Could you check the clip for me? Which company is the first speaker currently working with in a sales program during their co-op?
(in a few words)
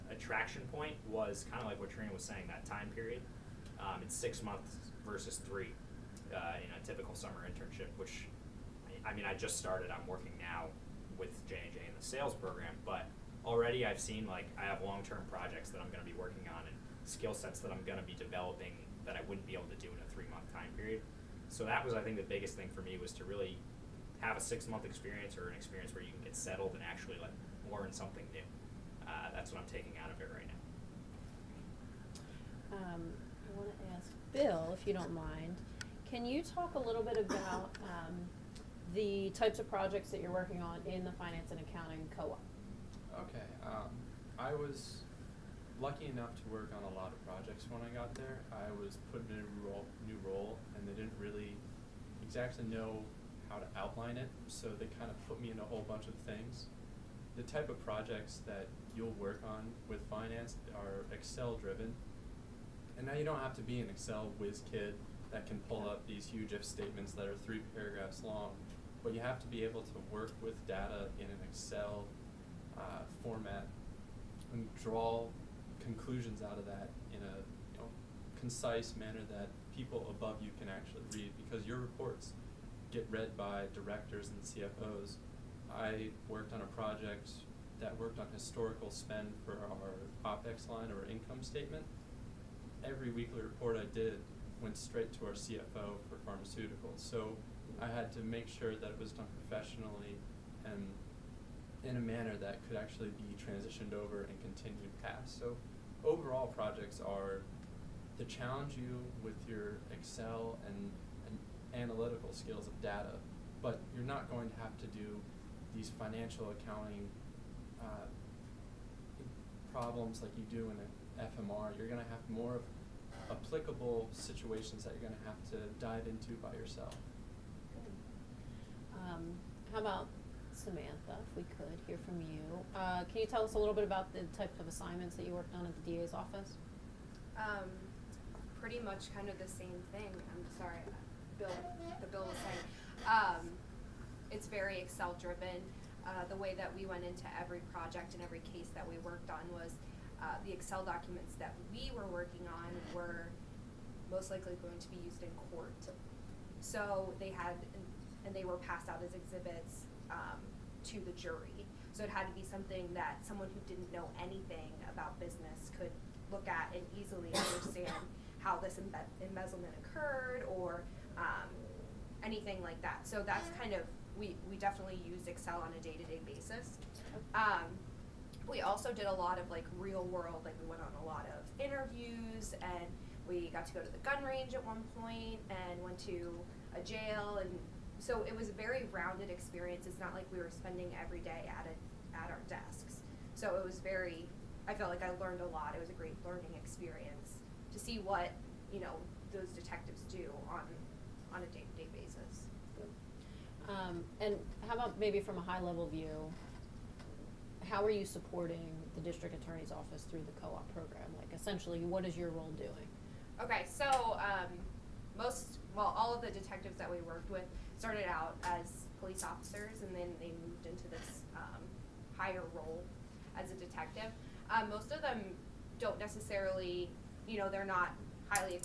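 J and J.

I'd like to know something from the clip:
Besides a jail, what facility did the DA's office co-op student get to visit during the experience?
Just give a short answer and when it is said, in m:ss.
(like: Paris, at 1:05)
gun range, at 3:03.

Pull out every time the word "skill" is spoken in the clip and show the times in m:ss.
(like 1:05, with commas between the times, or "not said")
0:17, 1:52.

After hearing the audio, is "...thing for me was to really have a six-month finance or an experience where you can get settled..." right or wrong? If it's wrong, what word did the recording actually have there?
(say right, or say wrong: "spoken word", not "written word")
wrong: "experience", not "finance".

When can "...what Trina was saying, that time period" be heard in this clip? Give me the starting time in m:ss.
0:01.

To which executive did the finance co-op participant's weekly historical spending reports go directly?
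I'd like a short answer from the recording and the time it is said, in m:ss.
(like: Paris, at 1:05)
CFO for pharmaceuticals, at 1:35.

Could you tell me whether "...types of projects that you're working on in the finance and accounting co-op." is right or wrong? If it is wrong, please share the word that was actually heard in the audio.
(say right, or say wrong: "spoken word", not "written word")
right.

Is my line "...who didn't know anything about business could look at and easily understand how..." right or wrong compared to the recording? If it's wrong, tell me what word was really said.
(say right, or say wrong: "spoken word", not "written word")
right.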